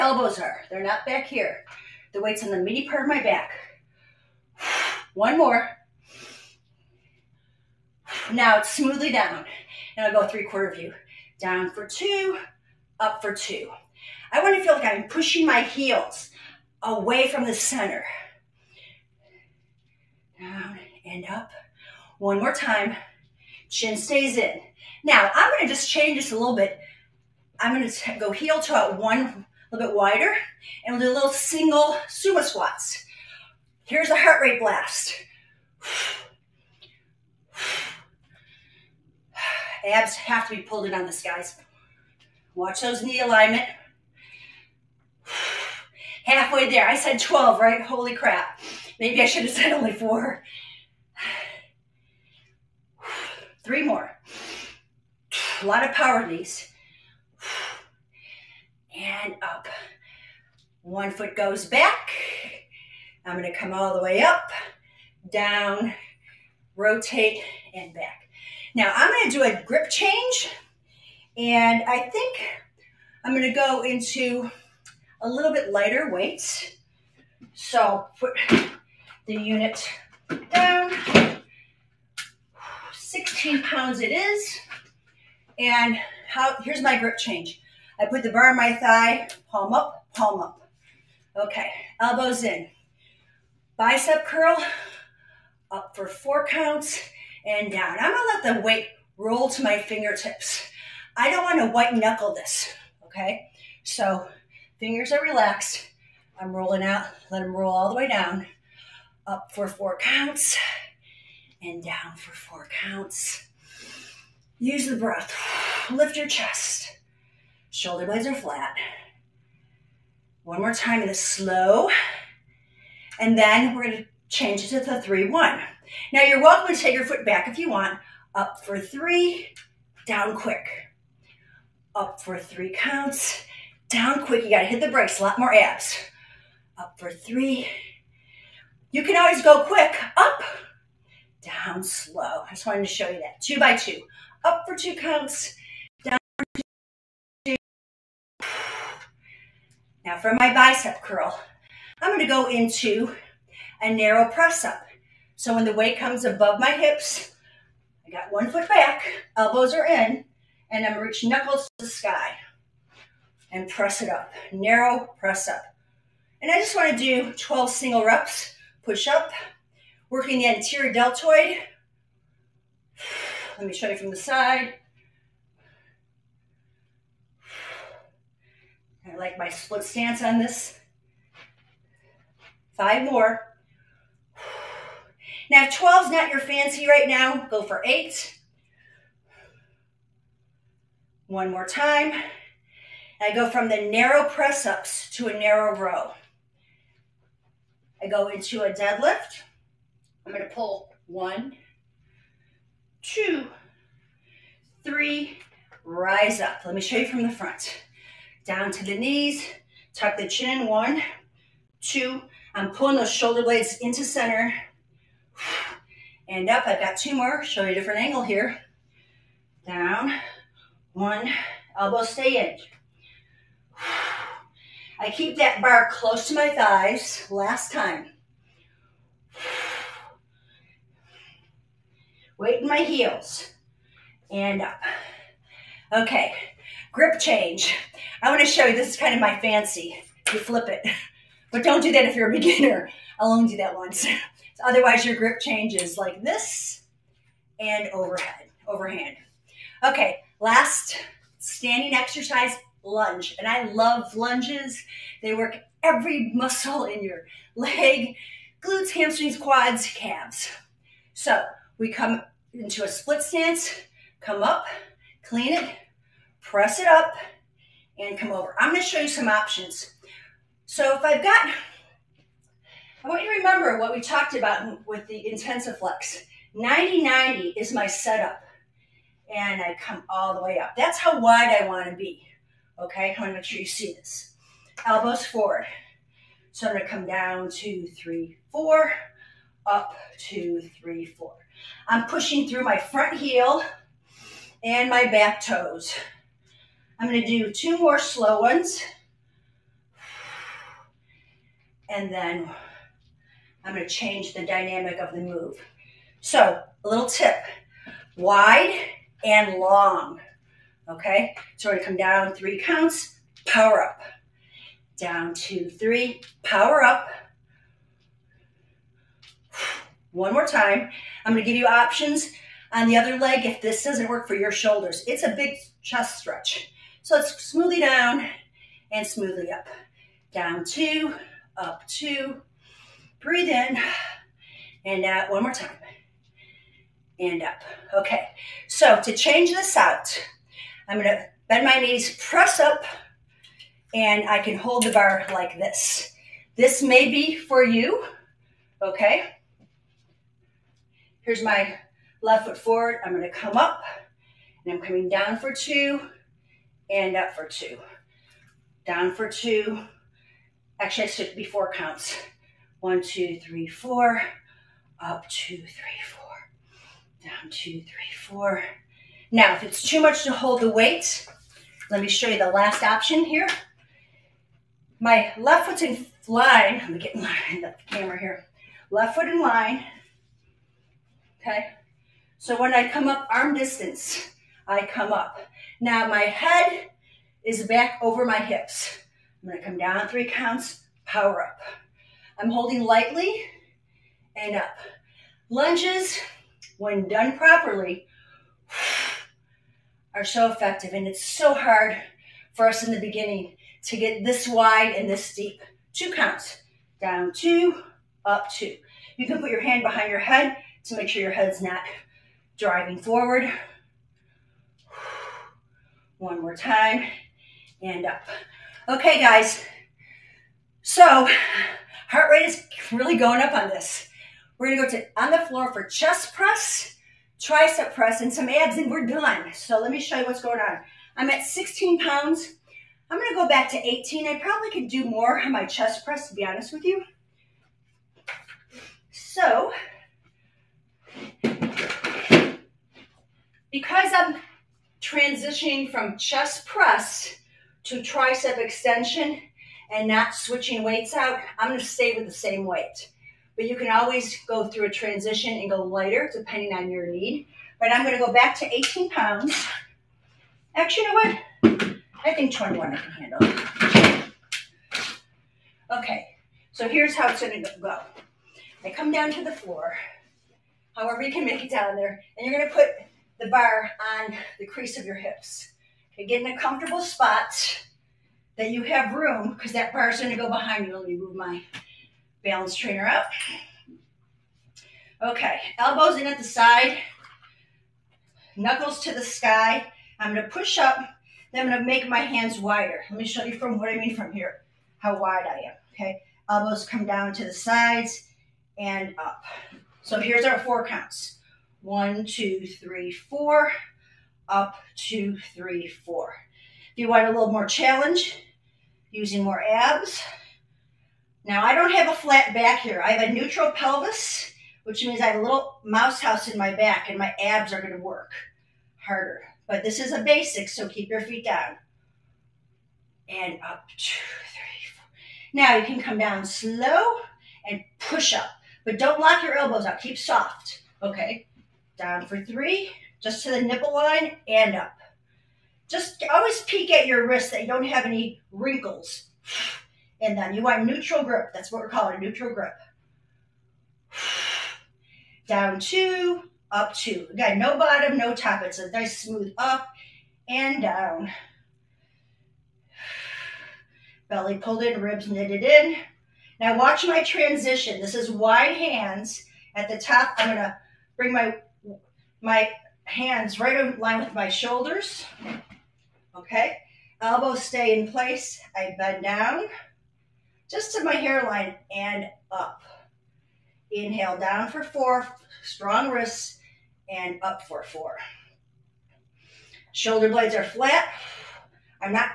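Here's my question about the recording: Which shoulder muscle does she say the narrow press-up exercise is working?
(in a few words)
anterior deltoid.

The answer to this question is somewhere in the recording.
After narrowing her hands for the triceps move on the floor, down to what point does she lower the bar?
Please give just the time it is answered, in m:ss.
9:31.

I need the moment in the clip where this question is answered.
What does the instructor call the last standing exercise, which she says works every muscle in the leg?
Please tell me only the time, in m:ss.
4:12.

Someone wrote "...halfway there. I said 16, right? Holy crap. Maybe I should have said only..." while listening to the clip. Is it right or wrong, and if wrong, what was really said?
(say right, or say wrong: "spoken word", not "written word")
wrong: "12", not "16".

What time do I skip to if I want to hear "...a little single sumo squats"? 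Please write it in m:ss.
0:31.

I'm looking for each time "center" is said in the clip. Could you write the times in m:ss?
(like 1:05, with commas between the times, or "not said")
0:17, 3:34.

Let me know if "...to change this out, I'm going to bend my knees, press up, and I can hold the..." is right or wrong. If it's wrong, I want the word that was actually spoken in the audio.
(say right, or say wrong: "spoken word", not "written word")
right.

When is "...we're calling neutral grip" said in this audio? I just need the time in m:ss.
9:01.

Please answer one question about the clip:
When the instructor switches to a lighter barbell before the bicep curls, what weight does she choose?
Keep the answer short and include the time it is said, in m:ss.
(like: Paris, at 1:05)
16 pounds, at 1:22.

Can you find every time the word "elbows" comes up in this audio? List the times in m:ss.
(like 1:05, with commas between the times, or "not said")
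1:31, 2:39, 3:41, 4:44, 8:05, 8:16, 8:49, 9:27.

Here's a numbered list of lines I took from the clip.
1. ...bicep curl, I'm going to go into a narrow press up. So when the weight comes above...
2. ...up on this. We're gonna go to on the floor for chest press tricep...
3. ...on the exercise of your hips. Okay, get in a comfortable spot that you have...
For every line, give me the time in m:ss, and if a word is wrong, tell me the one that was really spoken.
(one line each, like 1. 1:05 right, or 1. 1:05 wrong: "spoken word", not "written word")
1. 2:30 right
2. 7:03 right
3. 7:54 wrong: "crease", not "exercise".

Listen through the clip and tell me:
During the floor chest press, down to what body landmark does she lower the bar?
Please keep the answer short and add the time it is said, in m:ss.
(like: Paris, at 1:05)
nipple line, at 8:53.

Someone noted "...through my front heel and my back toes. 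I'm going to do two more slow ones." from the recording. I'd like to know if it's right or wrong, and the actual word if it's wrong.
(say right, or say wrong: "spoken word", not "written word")
right.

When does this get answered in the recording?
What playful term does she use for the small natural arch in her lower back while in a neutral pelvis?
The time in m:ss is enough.
8:35.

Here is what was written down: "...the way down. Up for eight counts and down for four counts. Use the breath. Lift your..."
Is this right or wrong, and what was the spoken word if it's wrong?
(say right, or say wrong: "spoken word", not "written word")
wrong: "four", not "eight".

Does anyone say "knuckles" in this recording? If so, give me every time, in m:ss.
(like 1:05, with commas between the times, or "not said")
1:41, 2:41, 8:08.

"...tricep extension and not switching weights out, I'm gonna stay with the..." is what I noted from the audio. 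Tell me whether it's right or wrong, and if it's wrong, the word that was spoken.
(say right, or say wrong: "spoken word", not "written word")
right.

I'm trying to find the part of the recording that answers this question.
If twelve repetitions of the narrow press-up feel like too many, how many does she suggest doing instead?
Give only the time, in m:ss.
3:07.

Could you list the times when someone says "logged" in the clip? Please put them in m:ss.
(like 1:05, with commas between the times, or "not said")
not said.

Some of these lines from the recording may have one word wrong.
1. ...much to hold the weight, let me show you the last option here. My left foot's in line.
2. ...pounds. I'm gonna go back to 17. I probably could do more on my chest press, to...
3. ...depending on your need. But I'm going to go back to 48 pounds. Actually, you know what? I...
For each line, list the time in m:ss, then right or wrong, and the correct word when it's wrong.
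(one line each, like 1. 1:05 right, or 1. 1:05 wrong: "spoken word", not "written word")
1. 6:09 right
2. 7:11 wrong: "18", not "17"
3. 7:36 wrong: "18", not "48".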